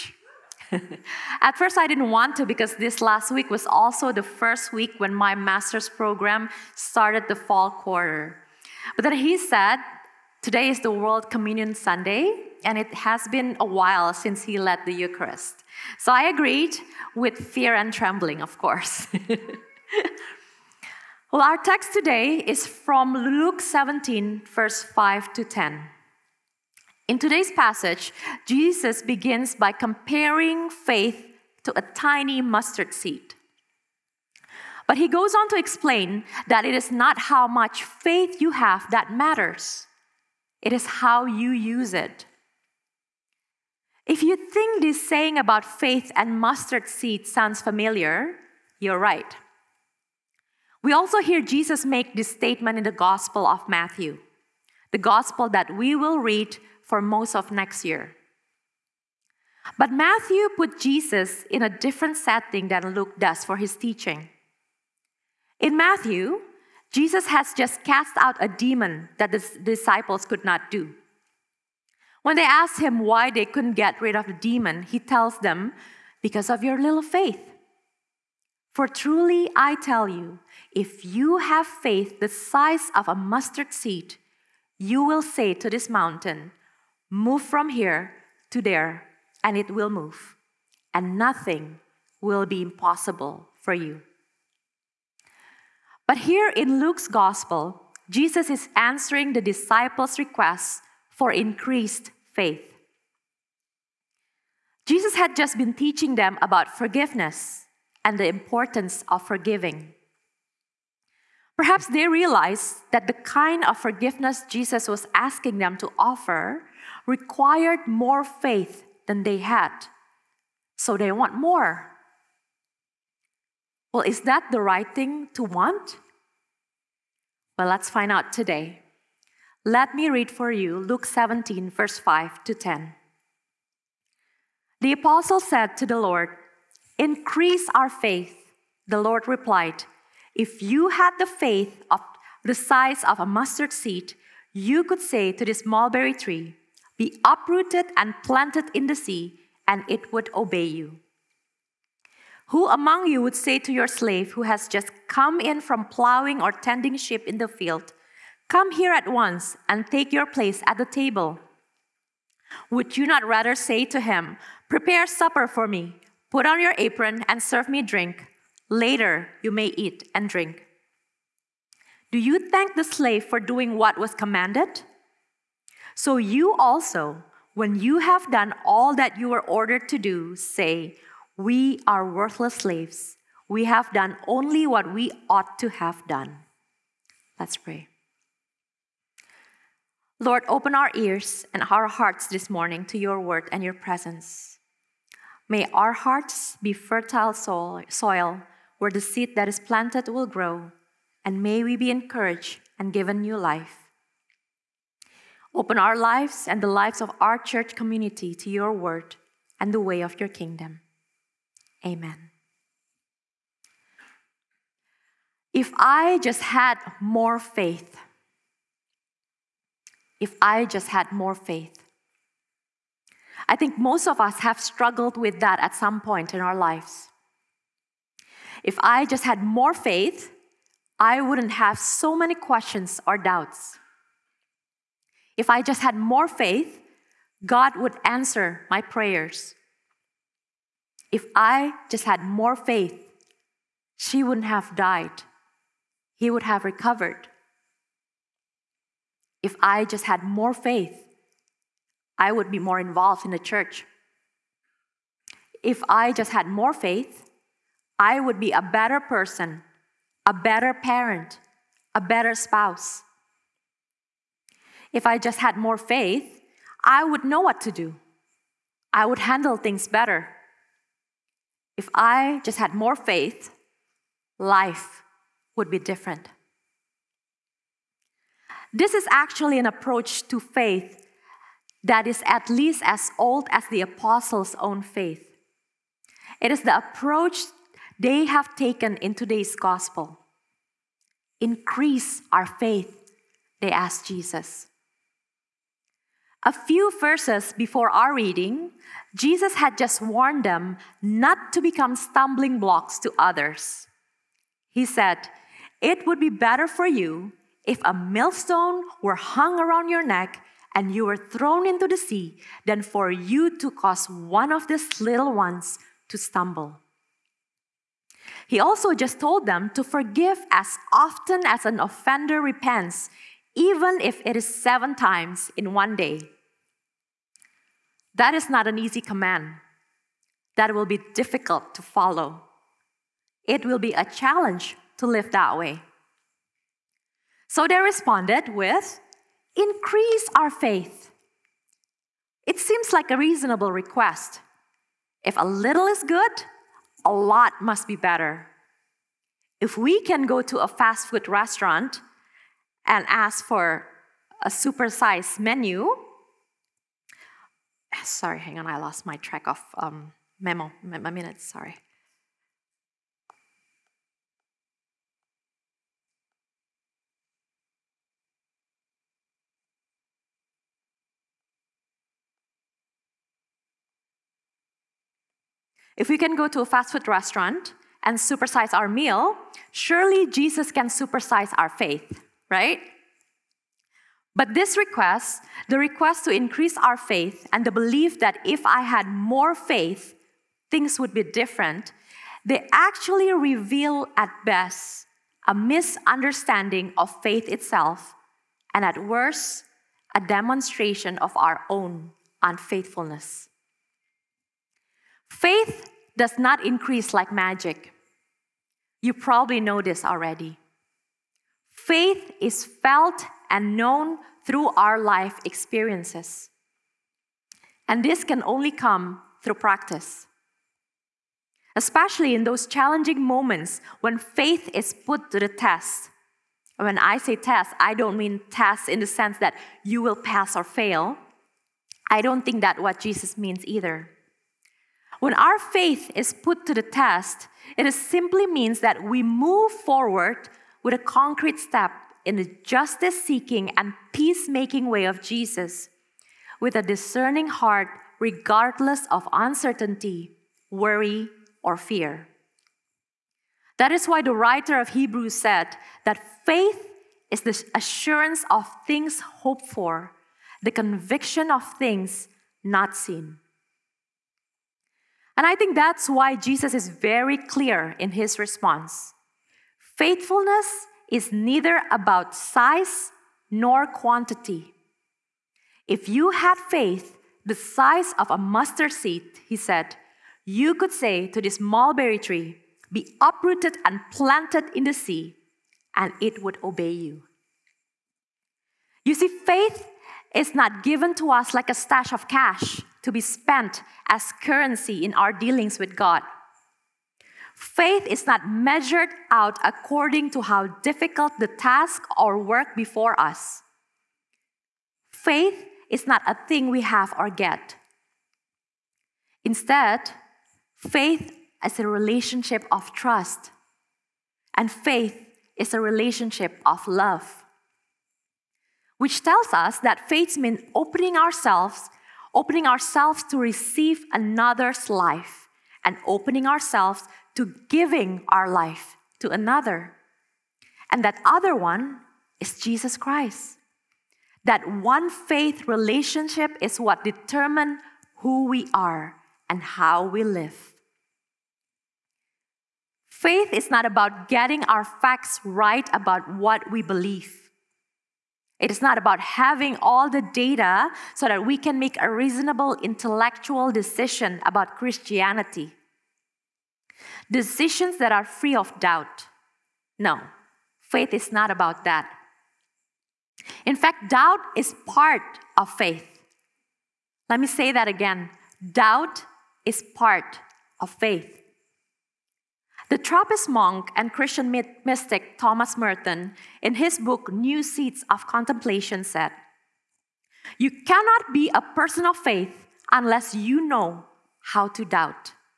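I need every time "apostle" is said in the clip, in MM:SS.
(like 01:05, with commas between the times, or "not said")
02:14, 04:43.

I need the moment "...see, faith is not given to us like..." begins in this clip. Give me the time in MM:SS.
08:09.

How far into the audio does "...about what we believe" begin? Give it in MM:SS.
09:05.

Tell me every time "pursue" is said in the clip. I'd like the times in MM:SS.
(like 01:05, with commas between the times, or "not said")
not said.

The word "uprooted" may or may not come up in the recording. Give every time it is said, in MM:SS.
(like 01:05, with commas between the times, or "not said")
02:27, 08:03.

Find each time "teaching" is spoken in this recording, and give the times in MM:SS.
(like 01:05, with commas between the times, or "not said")
01:03, 01:45.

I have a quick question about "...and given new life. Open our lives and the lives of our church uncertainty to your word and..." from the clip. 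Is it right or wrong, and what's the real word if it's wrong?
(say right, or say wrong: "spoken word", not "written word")
wrong: "community", not "uncertainty".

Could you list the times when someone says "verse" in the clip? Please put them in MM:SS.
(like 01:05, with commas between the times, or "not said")
00:24, 02:11, 04:56.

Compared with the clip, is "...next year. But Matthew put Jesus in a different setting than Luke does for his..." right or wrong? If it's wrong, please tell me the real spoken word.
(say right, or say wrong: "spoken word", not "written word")
right.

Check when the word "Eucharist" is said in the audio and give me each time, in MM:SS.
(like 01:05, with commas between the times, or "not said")
00:14.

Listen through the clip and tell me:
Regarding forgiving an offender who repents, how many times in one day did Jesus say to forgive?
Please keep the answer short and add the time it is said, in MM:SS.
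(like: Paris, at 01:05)
7, at 05:24.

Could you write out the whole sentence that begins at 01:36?
But here in Luke's gospel, Jesus is answering the disciples' request for increased faith.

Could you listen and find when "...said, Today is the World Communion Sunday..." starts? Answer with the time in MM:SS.
00:09.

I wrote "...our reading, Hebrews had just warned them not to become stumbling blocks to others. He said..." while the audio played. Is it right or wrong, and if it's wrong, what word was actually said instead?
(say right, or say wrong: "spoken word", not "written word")
wrong: "Jesus", not "Hebrews".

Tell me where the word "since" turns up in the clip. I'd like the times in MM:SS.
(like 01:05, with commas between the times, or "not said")
00:14.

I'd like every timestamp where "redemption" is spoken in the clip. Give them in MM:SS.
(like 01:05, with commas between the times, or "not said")
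not said.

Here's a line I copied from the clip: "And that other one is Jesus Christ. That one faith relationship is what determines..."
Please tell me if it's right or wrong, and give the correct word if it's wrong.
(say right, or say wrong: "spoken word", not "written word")
right.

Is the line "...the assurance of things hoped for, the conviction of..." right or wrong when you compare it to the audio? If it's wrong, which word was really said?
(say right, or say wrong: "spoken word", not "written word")
right.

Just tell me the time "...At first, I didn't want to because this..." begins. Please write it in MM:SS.
00:01.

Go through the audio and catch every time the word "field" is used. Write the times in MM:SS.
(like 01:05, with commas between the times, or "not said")
02:37.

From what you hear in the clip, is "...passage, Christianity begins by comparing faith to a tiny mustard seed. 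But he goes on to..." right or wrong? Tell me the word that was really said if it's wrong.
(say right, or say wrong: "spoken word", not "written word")
wrong: "Jesus", not "Christianity".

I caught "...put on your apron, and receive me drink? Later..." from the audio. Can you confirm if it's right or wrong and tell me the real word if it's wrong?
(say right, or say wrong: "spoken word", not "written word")
wrong: "serve", not "receive".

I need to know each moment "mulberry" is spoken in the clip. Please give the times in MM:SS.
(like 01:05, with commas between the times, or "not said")
02:25, 08:01.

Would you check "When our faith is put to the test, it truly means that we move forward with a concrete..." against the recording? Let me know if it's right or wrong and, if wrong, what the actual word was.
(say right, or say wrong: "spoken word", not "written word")
wrong: "simply", not "truly".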